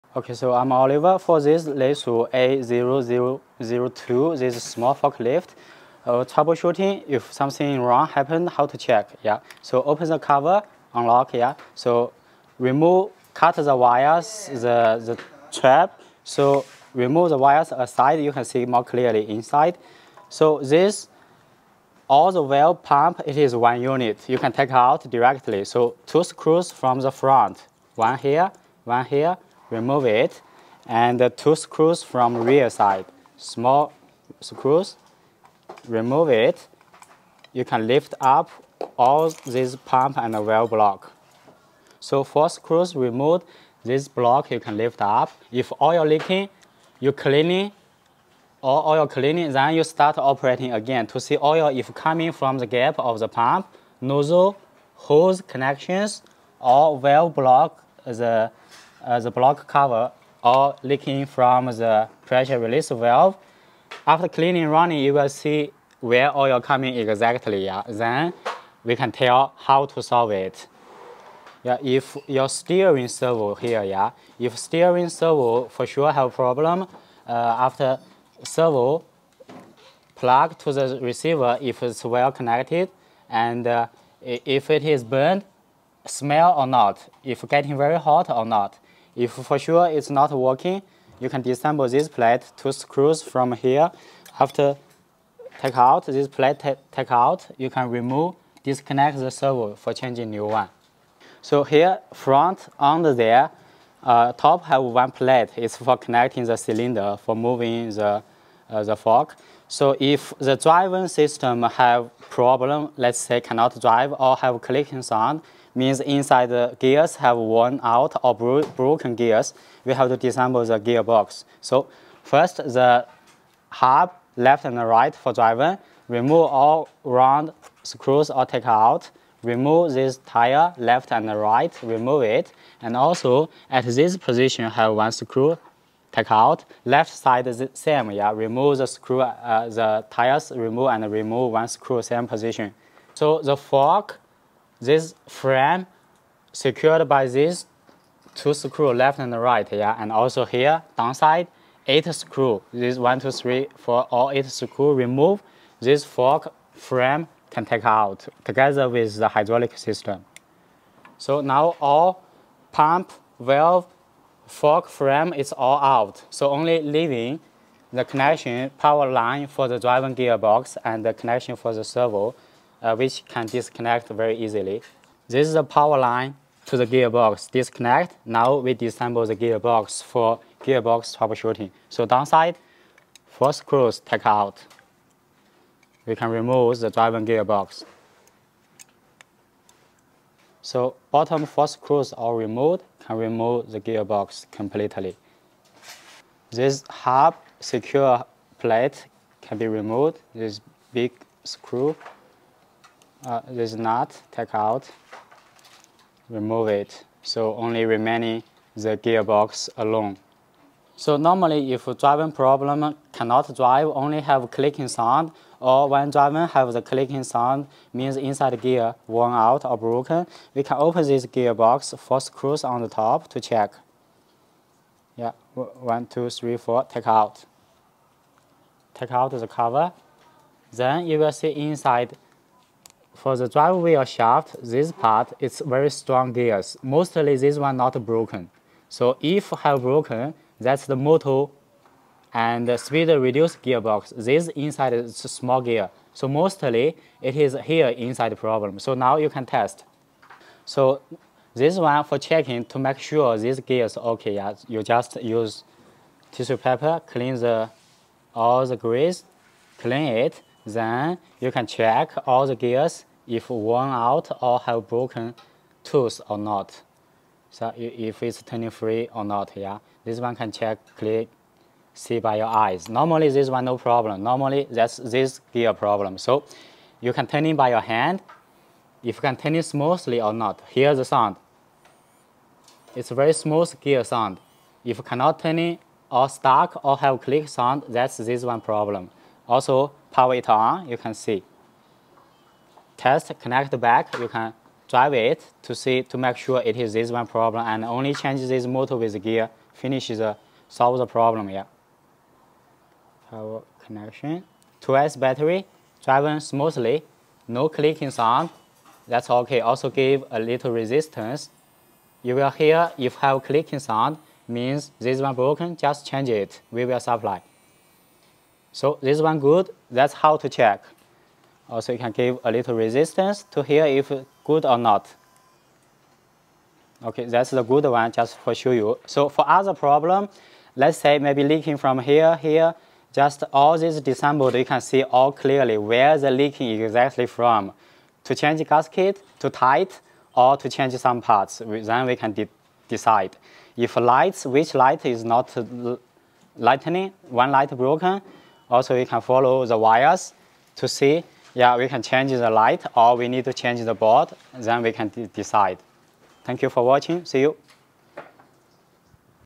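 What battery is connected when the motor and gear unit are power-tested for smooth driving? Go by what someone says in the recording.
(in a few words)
2S battery.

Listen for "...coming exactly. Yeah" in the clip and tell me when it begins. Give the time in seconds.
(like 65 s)
66 s.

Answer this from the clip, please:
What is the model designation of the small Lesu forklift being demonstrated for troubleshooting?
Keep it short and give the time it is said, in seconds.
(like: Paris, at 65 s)
A0002, at 2 s.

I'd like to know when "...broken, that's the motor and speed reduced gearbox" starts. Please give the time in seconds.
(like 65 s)
239 s.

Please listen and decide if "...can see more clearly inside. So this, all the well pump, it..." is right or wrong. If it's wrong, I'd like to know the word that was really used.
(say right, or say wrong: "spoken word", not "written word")
right.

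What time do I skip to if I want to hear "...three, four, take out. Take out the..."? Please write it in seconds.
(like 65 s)
226 s.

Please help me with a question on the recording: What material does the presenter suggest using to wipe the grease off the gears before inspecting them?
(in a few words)
Tissue paper.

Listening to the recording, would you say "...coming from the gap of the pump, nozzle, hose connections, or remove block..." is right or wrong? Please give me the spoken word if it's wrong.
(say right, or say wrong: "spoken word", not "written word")
wrong: "valve", not "remove".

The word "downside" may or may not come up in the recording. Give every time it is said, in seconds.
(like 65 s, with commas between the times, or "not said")
150 s, 182 s.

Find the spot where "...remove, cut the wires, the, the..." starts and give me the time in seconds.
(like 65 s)
12 s.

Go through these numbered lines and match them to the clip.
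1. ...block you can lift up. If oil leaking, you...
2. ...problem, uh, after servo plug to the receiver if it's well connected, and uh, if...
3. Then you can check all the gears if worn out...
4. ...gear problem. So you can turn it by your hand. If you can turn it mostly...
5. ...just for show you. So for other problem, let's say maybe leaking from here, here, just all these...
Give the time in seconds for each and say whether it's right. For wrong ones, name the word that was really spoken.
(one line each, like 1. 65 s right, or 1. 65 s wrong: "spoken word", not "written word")
1. 44 s right
2. 76 s right
3. 260 s right
4. 275 s wrong: "smoothly", not "mostly"
5. 328 s right.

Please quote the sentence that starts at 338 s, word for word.
To change gasket, to tight, or to change some parts, then we can de decide.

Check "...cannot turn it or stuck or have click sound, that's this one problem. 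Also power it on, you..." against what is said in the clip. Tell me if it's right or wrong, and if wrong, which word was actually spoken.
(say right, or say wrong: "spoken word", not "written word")
right.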